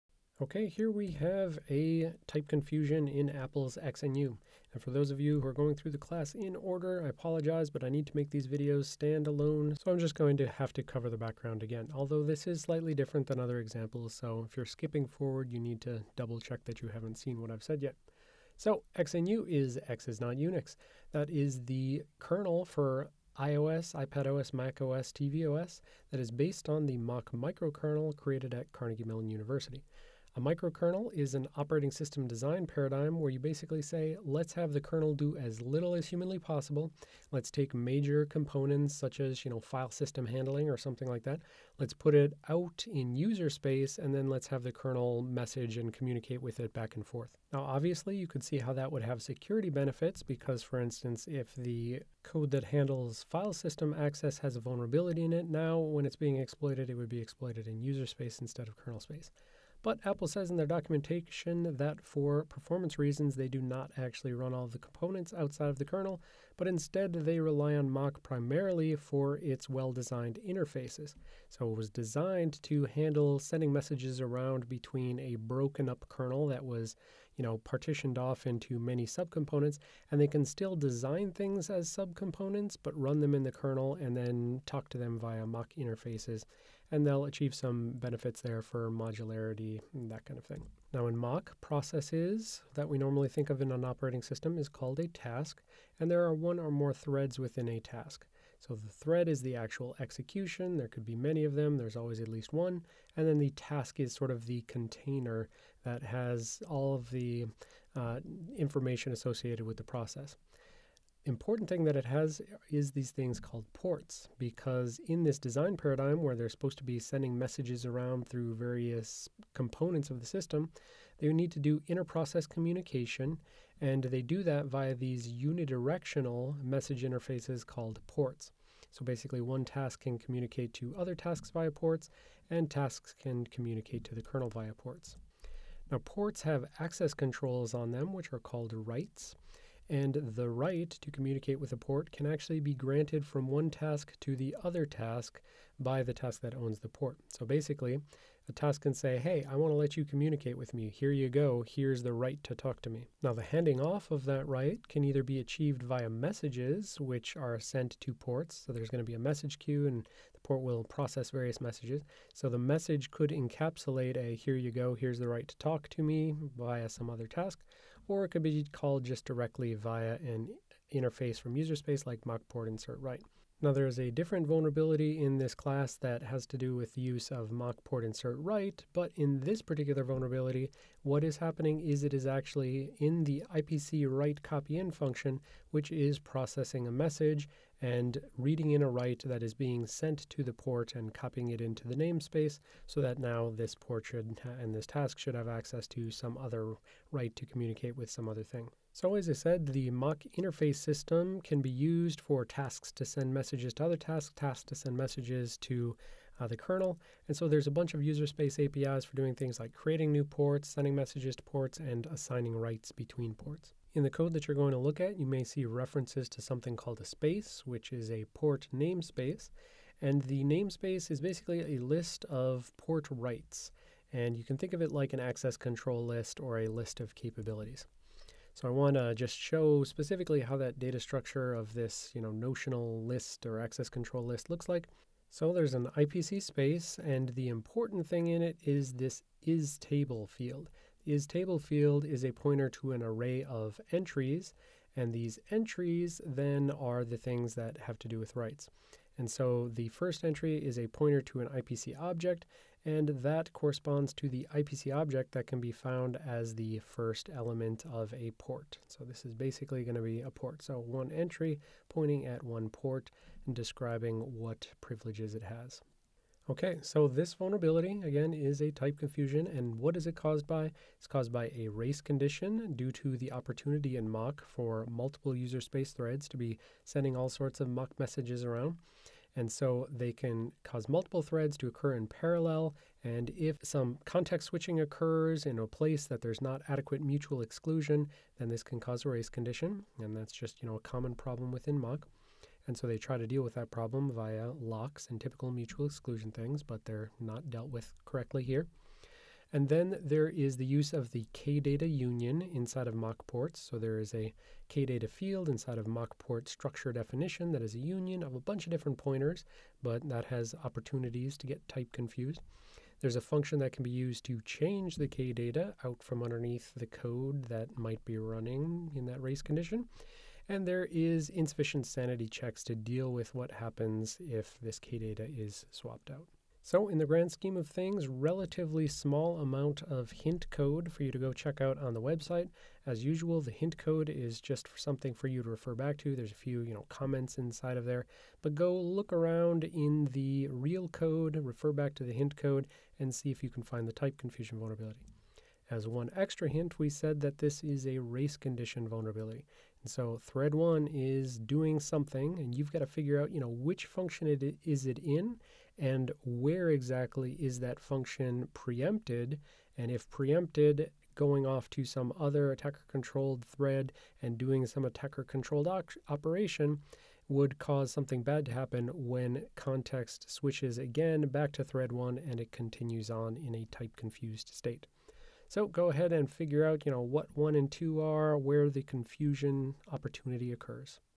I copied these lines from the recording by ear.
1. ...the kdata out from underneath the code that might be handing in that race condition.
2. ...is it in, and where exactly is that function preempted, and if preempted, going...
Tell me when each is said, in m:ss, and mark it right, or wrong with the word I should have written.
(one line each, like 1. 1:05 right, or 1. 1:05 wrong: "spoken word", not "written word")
1. 5:14 wrong: "running", not "handing"
2. 5:54 right.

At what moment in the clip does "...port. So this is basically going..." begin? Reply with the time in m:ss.
4:18.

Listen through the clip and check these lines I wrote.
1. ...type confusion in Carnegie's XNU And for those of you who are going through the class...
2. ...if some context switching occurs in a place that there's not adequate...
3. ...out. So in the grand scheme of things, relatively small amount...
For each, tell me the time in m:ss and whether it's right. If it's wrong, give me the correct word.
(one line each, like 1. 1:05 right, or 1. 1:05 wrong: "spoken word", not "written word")
1. 0:02 wrong: "Apple", not "Carnegie"
2. 4:43 right
3. 5:26 right.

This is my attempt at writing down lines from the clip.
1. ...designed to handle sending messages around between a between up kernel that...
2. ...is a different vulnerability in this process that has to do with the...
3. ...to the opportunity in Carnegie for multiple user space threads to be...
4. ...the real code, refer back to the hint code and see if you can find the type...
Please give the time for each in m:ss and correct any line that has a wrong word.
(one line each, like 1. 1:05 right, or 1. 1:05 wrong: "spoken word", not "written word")
1. 1:11 wrong: "broken", not "between"
2. 2:53 wrong: "class", not "process"
3. 4:32 wrong: "Mach", not "Carnegie"
4. 5:40 right.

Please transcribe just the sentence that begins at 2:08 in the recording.
So basically, one task can communicate to other tasks via ports, and tasks can communicate to the kernel via ports.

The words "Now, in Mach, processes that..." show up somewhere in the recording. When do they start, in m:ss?
1:30.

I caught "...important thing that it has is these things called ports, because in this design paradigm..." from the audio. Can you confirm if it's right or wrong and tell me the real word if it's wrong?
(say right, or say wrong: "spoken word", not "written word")
right.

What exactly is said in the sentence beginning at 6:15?
So go ahead and figure out, you know, what one and two are, where the confusion opportunity occurs.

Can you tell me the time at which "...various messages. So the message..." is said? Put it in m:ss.
2:41.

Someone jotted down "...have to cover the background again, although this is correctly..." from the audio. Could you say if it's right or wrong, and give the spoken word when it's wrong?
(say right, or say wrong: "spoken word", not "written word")
wrong: "slightly", not "correctly".